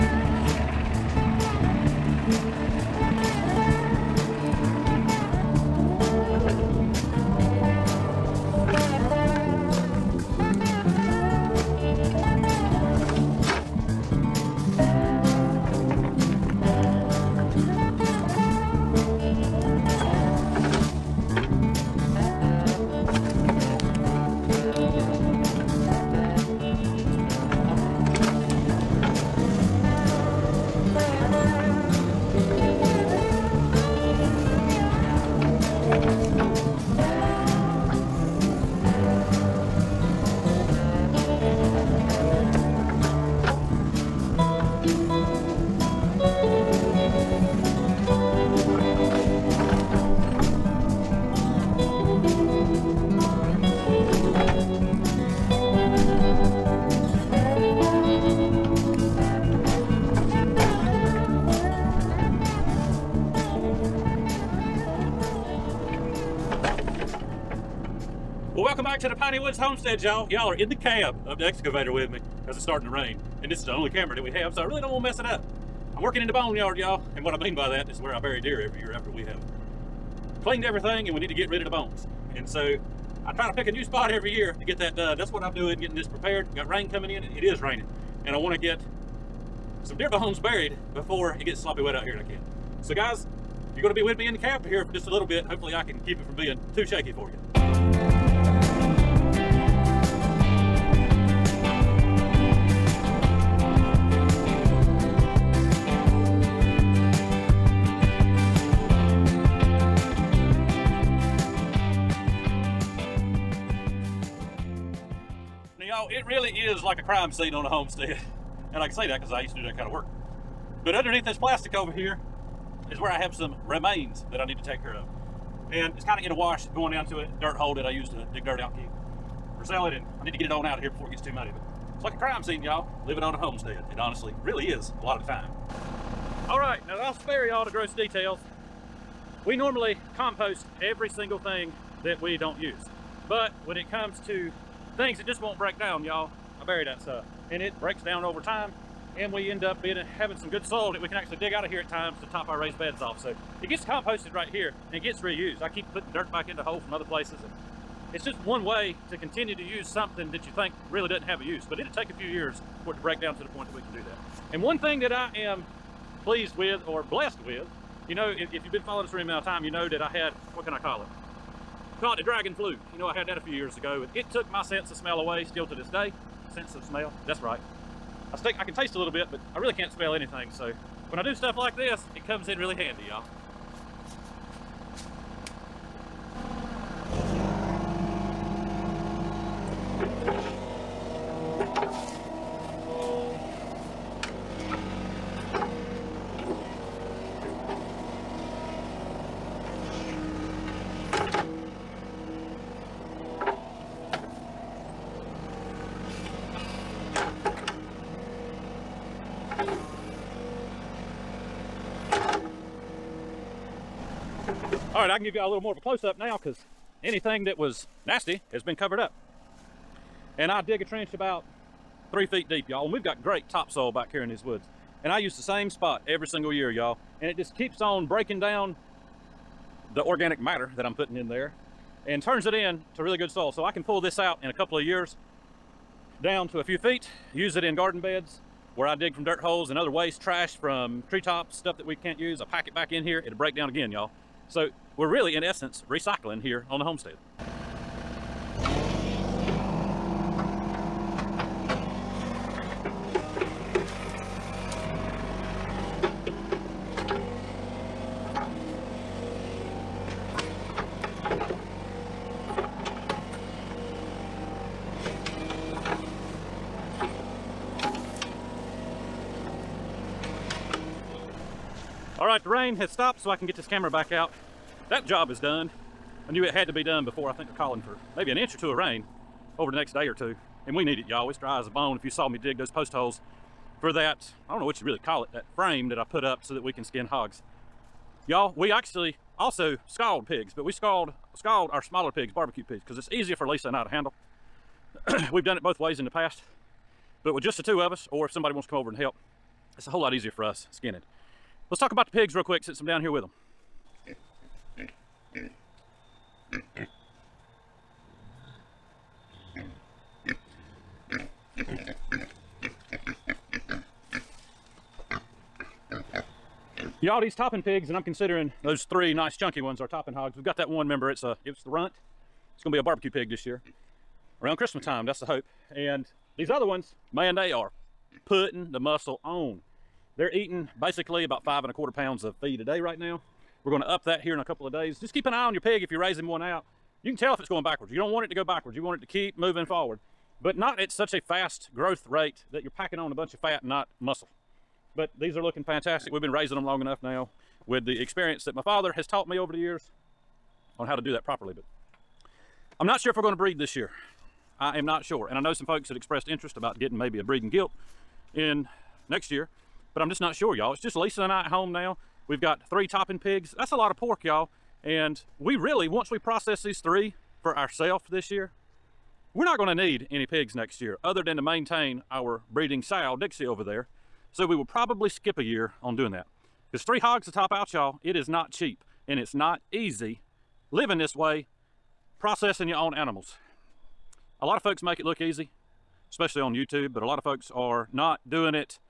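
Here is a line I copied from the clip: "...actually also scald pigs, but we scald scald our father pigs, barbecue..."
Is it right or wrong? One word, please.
wrong.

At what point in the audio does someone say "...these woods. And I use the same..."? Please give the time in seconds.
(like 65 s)
224 s.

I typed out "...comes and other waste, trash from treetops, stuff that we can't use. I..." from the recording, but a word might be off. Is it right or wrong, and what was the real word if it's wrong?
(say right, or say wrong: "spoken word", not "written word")
wrong: "holes", not "comes".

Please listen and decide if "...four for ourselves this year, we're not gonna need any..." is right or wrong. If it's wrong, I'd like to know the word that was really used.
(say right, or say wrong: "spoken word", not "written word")
wrong: "three", not "four".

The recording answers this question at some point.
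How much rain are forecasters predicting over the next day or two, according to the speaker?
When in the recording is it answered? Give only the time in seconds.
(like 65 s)
278 s.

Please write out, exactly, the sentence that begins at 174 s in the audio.
And it took my sense of smell away still to this day.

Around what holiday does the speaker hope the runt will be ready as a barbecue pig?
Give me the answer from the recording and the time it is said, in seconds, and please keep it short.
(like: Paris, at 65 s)
Christmas, at 324 s.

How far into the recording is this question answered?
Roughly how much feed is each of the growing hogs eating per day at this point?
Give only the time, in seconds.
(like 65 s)
331 s.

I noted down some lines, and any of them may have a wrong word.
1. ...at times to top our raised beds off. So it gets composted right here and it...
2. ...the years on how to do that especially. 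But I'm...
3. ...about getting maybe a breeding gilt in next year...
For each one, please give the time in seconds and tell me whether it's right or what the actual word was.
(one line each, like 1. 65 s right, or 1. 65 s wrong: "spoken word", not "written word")
1. 151 s right
2. 349 s wrong: "properly", not "especially"
3. 356 s right.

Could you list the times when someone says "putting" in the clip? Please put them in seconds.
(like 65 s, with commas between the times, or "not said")
155 s, 230 s, 328 s.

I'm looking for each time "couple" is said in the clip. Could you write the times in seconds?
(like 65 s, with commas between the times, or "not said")
234 s, 334 s.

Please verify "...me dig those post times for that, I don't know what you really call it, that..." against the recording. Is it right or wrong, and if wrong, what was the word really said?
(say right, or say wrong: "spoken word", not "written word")
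wrong: "holes", not "times".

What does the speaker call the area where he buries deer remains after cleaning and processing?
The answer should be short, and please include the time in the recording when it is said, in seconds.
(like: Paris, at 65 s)
the boneyard, at 76 s.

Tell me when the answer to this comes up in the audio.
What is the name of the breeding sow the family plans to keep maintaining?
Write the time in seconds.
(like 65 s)
373 s.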